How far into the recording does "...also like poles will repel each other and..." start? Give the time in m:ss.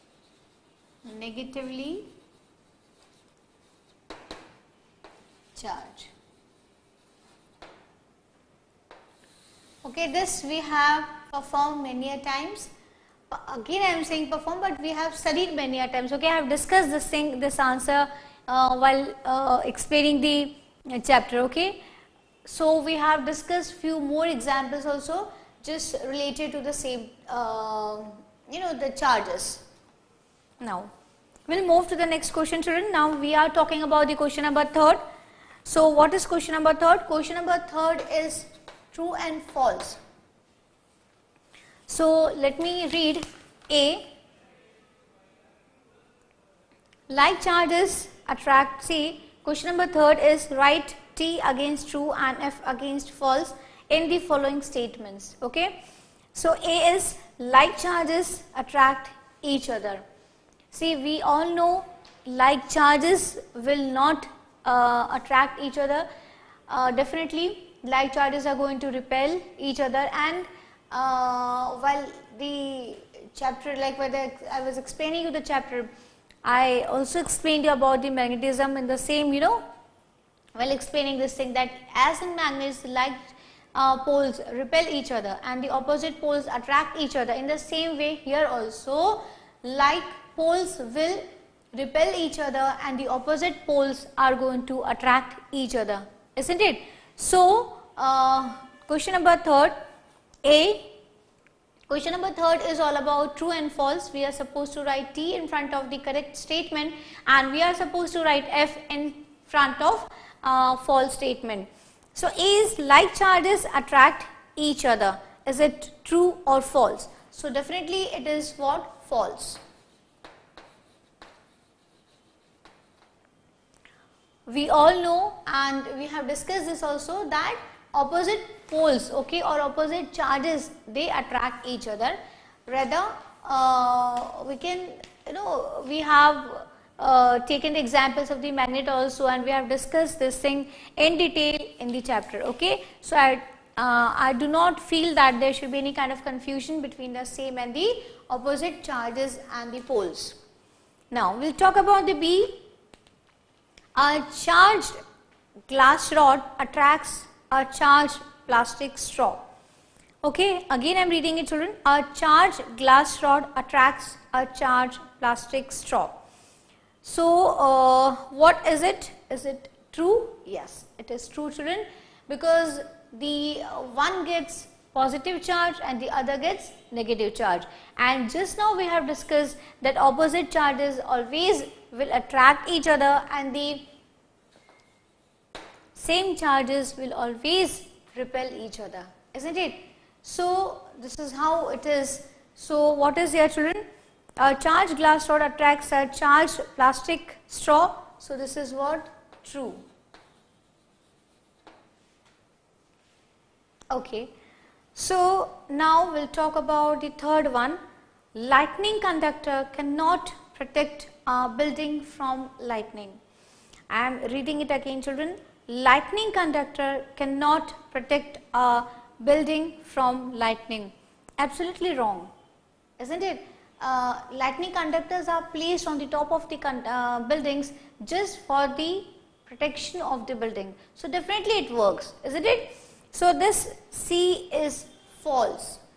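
1:28.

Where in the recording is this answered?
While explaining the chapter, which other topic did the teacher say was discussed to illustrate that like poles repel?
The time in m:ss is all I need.
1:18.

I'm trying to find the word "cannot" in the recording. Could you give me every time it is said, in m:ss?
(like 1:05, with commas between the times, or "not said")
3:29, 3:37.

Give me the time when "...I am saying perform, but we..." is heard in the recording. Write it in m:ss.
0:13.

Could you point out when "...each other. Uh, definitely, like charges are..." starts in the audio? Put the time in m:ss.
1:05.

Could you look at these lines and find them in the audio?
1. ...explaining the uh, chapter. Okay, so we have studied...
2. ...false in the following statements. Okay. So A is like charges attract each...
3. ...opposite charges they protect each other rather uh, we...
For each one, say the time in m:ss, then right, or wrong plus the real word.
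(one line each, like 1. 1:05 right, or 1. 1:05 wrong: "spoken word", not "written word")
1. 0:19 wrong: "discussed", not "studied"
2. 0:53 right
3. 2:09 wrong: "attract", not "protect".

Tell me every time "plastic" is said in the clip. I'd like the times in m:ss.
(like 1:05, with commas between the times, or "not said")
2:38, 2:45, 3:16.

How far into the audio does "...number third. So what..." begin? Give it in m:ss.
0:34.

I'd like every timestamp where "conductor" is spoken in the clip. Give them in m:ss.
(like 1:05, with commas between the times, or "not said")
3:29, 3:36, 3:44.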